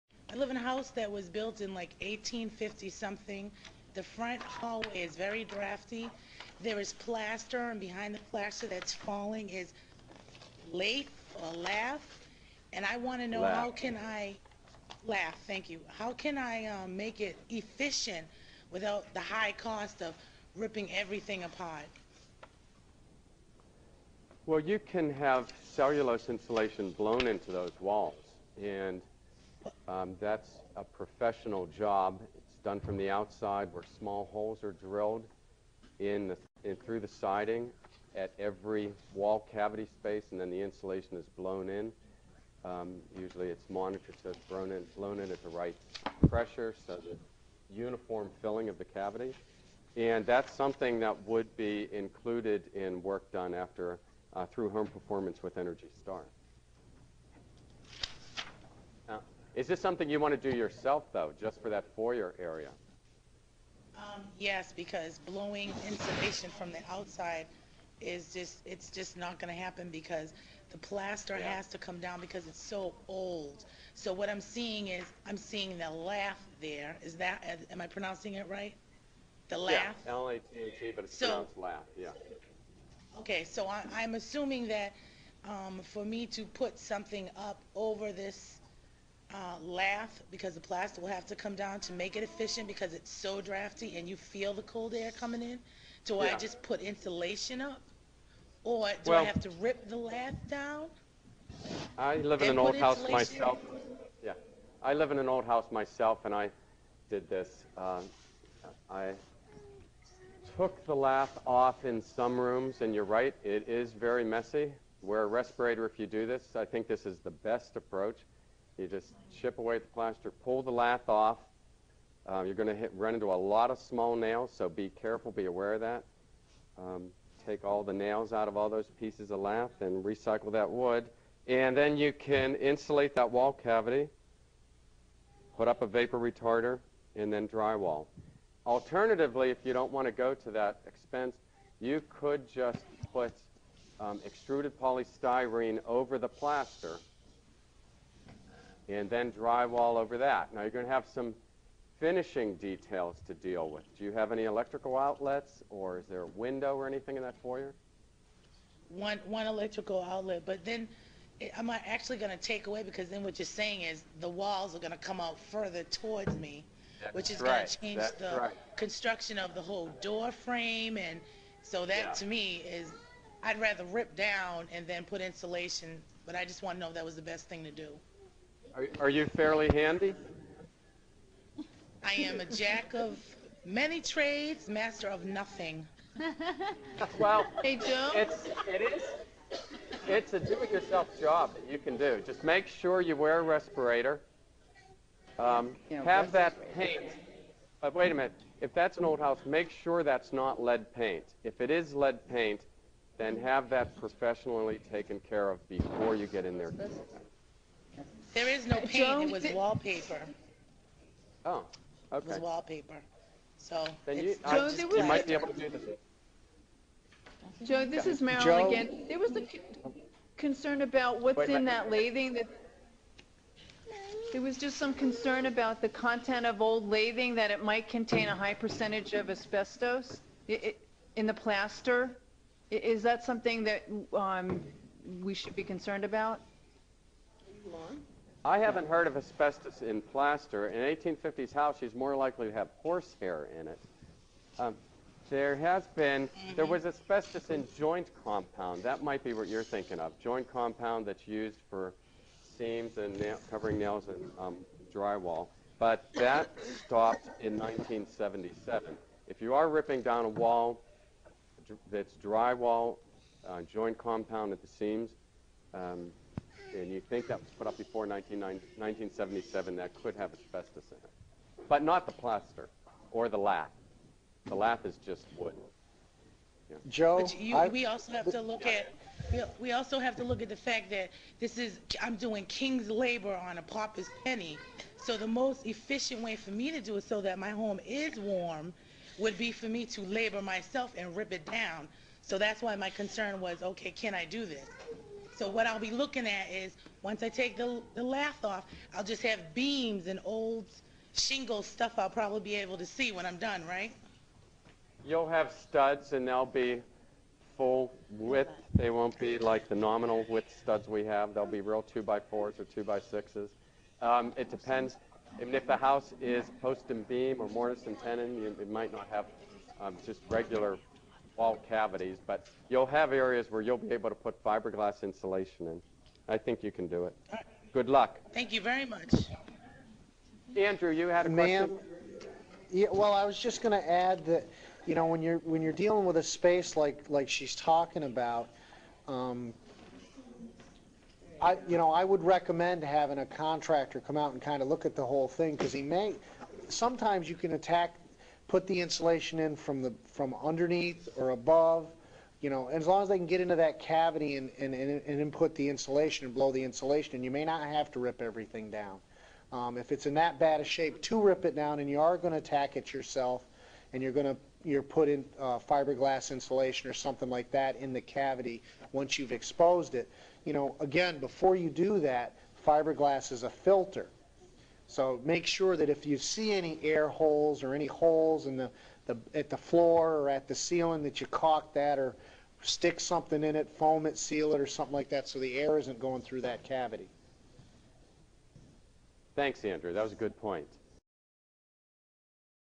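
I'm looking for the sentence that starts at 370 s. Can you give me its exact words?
You know, again, before you do that, fiberglass is a filter.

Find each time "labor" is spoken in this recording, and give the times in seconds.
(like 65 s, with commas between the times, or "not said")
282 s, 290 s.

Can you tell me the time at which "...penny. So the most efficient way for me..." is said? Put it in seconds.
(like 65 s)
284 s.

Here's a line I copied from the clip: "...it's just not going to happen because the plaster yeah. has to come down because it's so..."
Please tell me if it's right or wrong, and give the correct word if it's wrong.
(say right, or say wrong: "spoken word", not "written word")
right.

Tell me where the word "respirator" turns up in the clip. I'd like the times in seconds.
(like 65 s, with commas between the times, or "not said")
115 s, 193 s.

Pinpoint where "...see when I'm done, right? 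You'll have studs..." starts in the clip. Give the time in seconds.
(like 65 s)
302 s.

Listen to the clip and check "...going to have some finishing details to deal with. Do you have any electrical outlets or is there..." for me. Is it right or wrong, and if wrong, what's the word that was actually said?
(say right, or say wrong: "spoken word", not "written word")
right.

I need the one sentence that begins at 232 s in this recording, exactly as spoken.
Is that something that um, we should be concerned about?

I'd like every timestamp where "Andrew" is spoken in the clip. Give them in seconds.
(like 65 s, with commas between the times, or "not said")
330 s, 389 s.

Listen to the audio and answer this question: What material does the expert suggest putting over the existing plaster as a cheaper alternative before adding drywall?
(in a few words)
extruded polystyrene.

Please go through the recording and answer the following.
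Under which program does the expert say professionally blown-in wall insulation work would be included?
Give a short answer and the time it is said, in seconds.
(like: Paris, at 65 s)
Home Performance with Energy Star, at 54 s.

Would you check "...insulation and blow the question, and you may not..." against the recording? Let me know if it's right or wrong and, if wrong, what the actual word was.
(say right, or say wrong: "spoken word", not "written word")
wrong: "insulation", not "question".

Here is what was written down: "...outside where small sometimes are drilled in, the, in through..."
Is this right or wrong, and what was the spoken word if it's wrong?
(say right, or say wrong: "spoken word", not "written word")
wrong: "holes", not "sometimes".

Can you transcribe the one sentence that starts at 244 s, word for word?
Um, there has been, there was asbestos in joint compound.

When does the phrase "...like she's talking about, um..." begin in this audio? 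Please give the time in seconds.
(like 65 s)
337 s.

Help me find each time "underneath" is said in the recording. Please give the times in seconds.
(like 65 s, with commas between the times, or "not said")
350 s.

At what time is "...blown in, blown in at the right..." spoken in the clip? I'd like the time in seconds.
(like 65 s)
44 s.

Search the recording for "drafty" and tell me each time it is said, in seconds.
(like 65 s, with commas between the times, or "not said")
5 s, 93 s.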